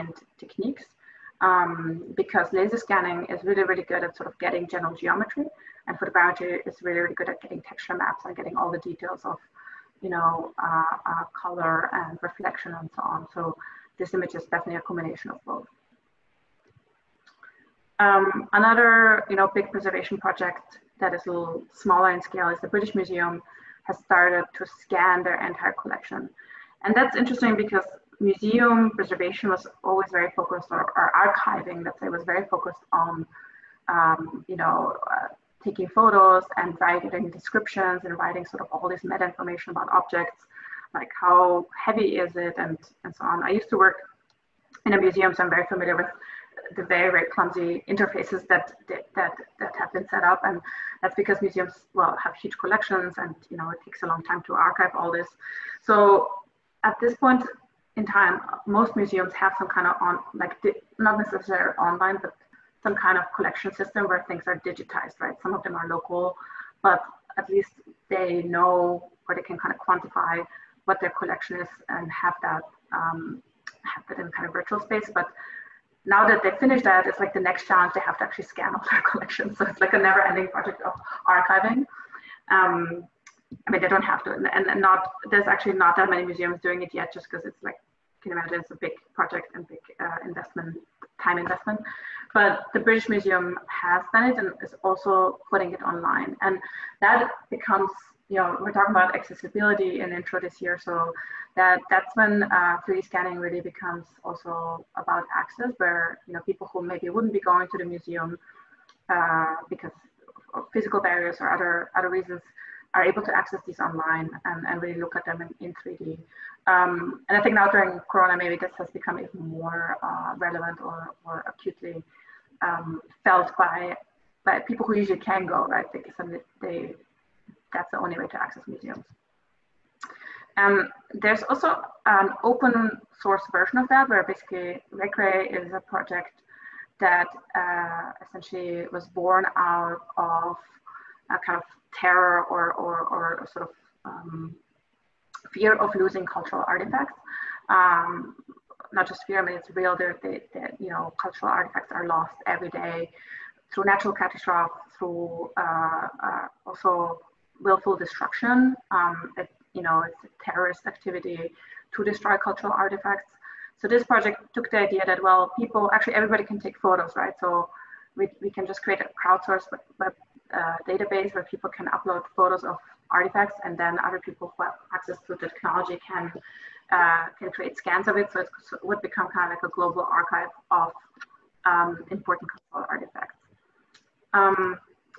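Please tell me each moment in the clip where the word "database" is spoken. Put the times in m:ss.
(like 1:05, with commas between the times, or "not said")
2:50.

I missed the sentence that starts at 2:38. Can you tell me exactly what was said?
Um, it, you know, it's terrorist activity to destroy cultural artifacts.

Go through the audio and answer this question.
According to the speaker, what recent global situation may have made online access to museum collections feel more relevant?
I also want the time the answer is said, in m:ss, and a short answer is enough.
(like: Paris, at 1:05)
Corona, at 1:58.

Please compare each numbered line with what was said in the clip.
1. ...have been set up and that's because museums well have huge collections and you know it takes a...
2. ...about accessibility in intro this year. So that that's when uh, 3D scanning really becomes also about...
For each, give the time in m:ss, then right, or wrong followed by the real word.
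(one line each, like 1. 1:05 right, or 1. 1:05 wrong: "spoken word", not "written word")
1. 0:49 right
2. 1:38 right.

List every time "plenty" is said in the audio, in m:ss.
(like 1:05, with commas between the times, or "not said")
not said.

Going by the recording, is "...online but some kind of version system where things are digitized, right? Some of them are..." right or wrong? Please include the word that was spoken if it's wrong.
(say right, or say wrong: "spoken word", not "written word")
wrong: "collection", not "version".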